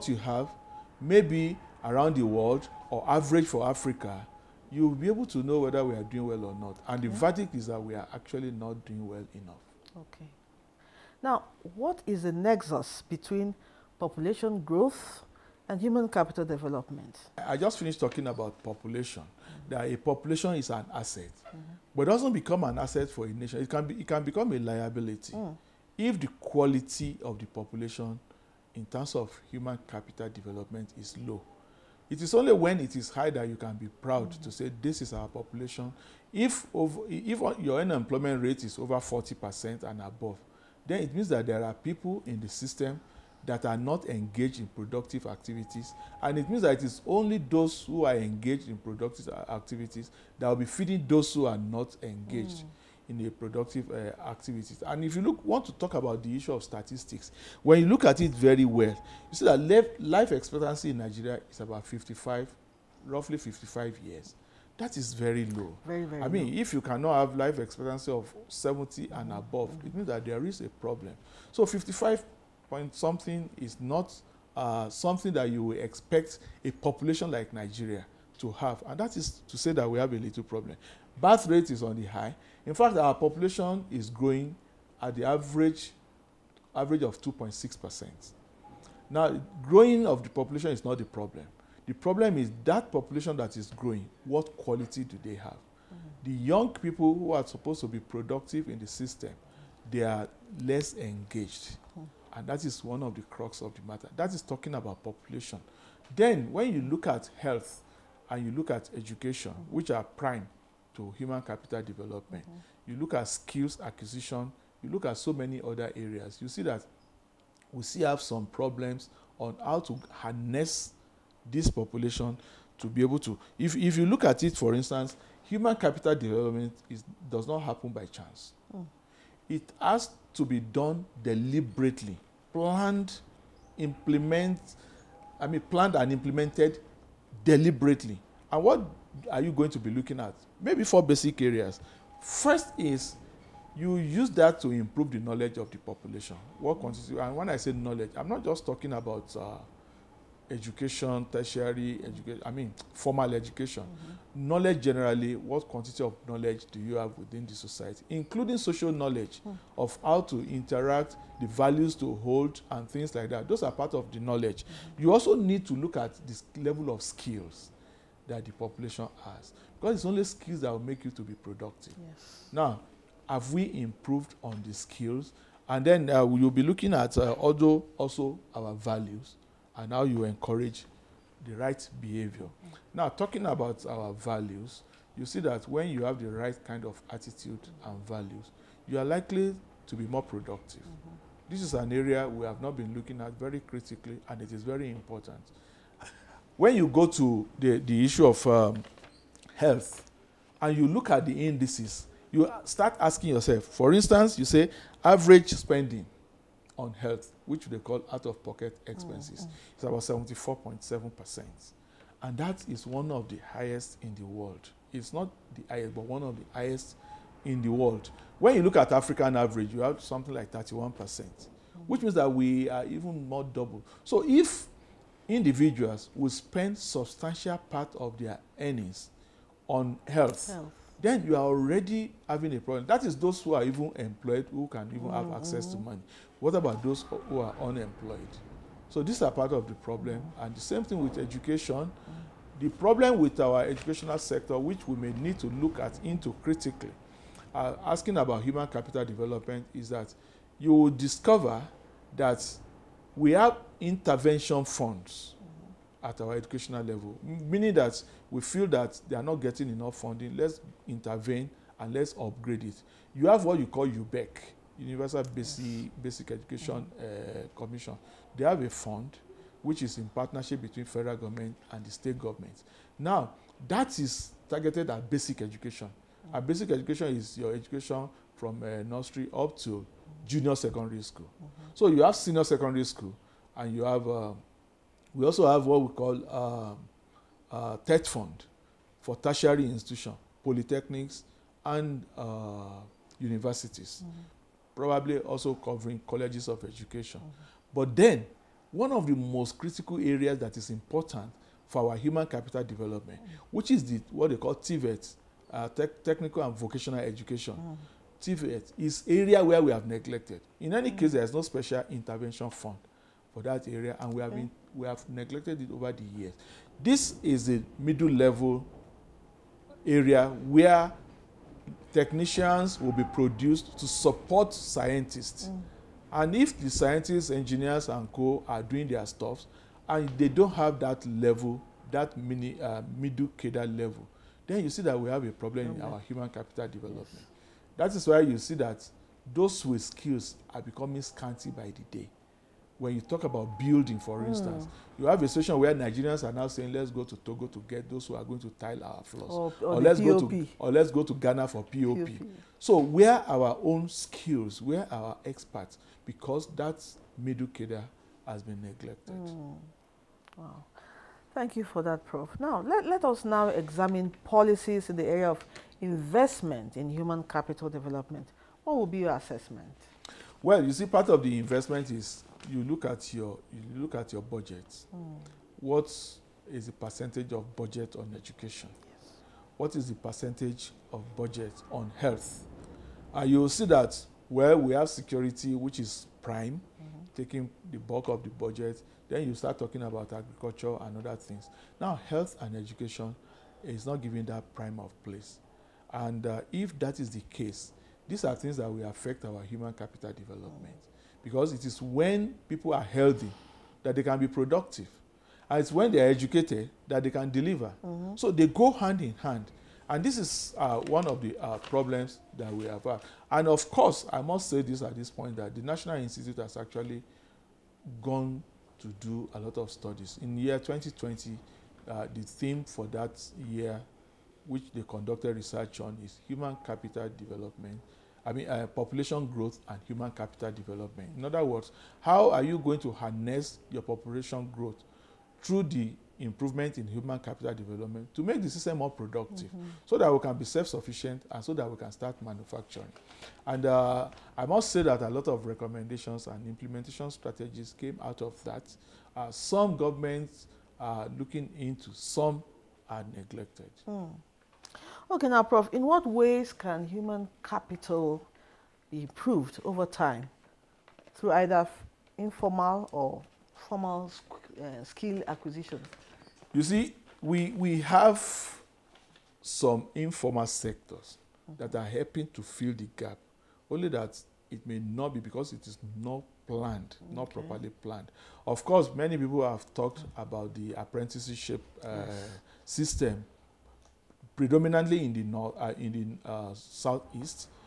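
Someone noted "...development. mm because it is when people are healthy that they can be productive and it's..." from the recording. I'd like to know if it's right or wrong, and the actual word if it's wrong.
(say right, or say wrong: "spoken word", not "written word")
right.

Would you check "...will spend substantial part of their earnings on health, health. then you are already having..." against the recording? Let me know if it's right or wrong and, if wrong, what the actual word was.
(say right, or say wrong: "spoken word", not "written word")
right.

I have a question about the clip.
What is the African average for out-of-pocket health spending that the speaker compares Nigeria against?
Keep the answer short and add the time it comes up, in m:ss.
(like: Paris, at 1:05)
31%, at 3:40.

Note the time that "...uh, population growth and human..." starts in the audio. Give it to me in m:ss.
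7:08.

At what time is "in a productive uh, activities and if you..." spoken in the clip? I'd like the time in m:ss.
0:53.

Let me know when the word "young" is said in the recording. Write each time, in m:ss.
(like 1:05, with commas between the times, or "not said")
1:36.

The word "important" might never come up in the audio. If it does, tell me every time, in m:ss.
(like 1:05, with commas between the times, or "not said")
3:14, 5:00.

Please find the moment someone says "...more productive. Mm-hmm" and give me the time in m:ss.
3:10.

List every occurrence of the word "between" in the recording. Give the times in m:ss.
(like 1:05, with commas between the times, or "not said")
0:13, 4:30.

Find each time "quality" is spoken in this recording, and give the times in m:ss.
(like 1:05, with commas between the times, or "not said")
0:26, 1:34.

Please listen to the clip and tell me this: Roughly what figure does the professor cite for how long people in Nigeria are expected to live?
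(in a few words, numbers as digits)
55 years.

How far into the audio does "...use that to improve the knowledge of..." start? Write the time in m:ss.
2:23.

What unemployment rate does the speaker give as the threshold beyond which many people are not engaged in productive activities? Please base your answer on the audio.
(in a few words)
40%.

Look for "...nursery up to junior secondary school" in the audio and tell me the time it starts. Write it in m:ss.
4:38.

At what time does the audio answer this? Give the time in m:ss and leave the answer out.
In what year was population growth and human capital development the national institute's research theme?
7:00.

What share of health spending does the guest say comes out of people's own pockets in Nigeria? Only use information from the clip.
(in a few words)
74.7%.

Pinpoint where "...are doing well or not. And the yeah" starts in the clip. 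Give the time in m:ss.
0:05.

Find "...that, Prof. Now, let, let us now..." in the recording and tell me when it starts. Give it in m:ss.
6:01.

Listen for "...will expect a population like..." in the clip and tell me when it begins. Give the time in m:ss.
1:15.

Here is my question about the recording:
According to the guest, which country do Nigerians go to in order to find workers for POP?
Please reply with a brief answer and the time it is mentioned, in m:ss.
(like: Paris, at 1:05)
Ghana, at 5:51.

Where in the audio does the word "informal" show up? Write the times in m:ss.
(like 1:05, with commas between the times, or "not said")
7:42, 7:49.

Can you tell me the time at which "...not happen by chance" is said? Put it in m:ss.
2:07.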